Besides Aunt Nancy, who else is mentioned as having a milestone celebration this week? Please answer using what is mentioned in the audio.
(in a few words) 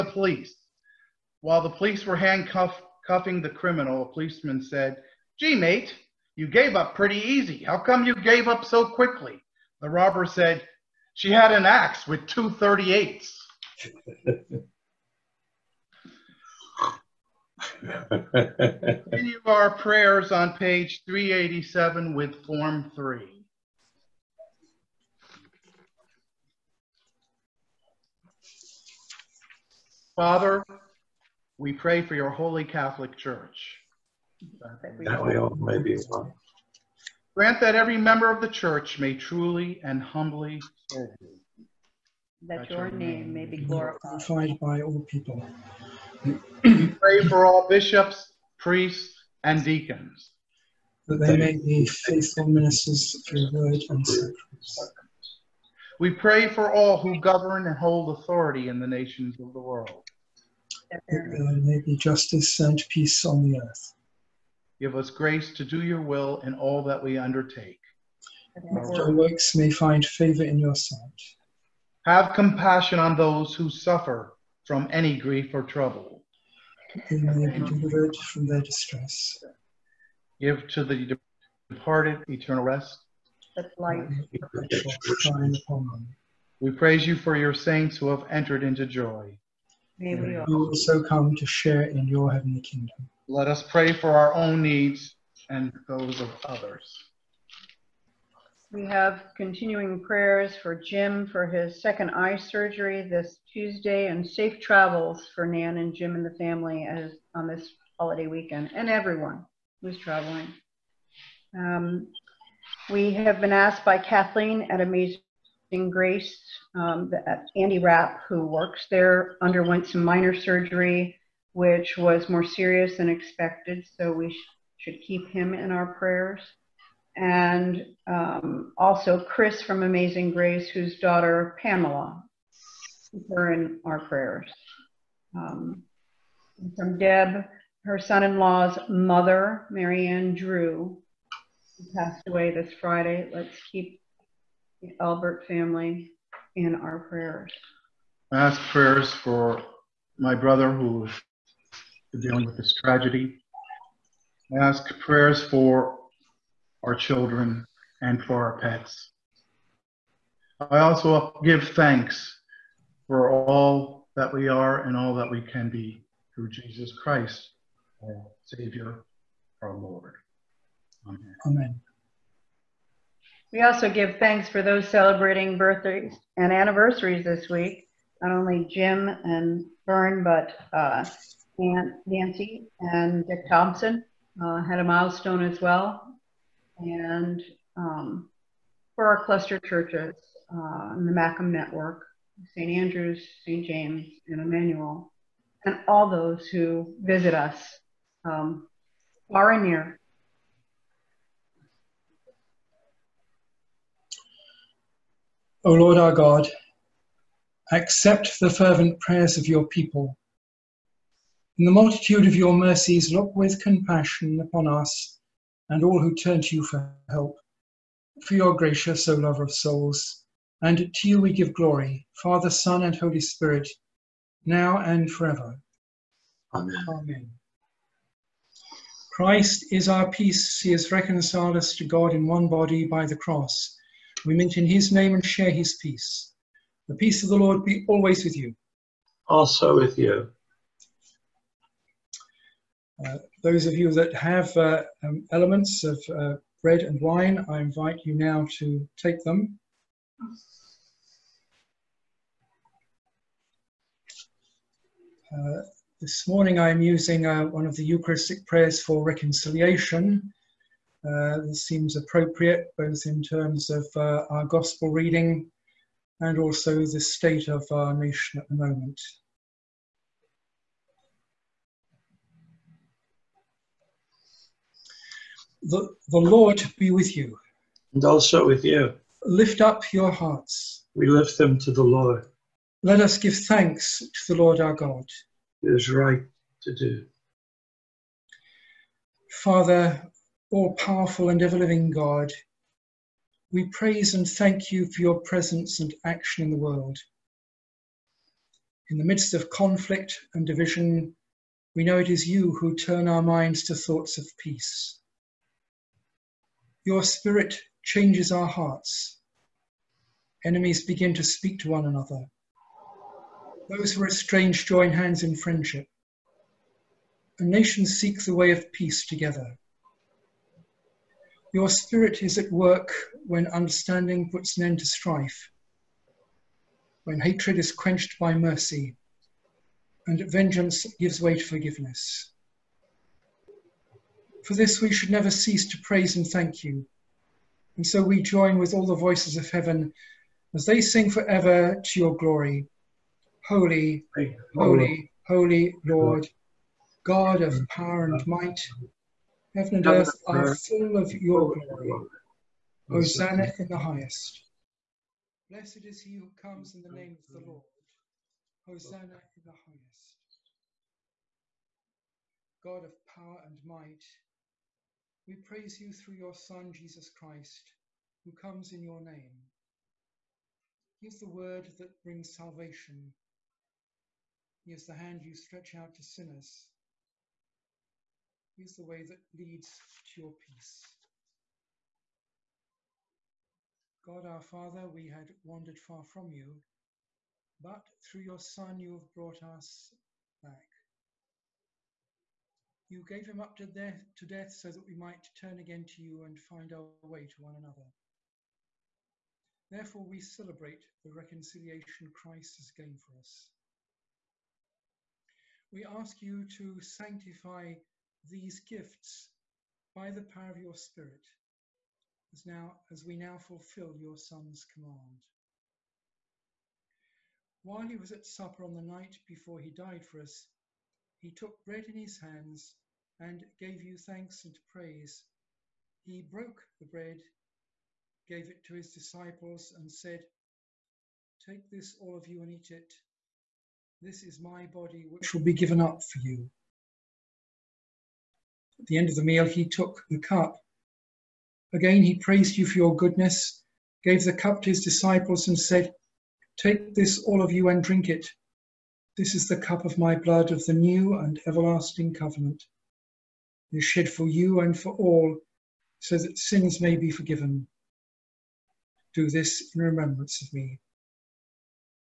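Dick Thompson.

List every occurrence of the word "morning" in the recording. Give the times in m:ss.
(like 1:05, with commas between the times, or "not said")
4:16.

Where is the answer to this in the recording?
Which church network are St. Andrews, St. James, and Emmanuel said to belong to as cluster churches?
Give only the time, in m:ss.
3:11.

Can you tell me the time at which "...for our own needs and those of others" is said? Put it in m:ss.
1:33.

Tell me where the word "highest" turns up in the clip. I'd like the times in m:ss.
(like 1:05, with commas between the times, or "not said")
5:53, 5:59.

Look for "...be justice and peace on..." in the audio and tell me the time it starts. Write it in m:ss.
1:01.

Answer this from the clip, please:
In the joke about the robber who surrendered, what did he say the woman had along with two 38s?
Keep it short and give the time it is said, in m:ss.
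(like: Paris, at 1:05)
An axe, at 0:11.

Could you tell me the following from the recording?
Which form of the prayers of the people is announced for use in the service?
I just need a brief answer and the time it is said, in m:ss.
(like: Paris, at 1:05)
Form 3, at 0:22.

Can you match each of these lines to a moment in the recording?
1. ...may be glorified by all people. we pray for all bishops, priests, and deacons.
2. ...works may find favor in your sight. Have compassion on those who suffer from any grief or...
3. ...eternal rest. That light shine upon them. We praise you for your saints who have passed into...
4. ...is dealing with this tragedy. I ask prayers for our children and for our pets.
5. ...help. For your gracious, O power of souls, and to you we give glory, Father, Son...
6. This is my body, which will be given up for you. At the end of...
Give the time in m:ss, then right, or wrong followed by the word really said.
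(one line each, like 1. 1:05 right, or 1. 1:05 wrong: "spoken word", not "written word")
1. 0:43 right
2. 1:09 right
3. 1:22 wrong: "entered", not "passed"
4. 2:31 right
5. 3:37 wrong: "lover", not "power"
6. 7:14 right.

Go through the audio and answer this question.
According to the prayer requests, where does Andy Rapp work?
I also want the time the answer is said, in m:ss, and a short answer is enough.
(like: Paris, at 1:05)
Amazing Grace, at 1:54.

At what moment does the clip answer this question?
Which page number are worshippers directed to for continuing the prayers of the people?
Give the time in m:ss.
0:21.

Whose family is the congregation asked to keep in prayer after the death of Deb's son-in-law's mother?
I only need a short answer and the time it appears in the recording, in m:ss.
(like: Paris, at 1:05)
The Albert family, at 2:25.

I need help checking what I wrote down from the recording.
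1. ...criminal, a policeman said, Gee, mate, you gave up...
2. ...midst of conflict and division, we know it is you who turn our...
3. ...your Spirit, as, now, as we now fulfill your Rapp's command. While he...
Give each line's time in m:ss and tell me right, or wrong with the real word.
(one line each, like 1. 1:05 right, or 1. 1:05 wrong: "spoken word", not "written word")
1. 0:03 right
2. 4:59 right
3. 6:50 wrong: "Son", not "Rapp".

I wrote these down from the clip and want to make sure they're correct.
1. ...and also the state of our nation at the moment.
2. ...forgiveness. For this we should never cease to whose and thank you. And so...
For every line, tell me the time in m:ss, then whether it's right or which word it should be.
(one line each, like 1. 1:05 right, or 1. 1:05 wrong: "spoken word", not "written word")
1. 4:26 right
2. 5:31 wrong: "praise", not "whose".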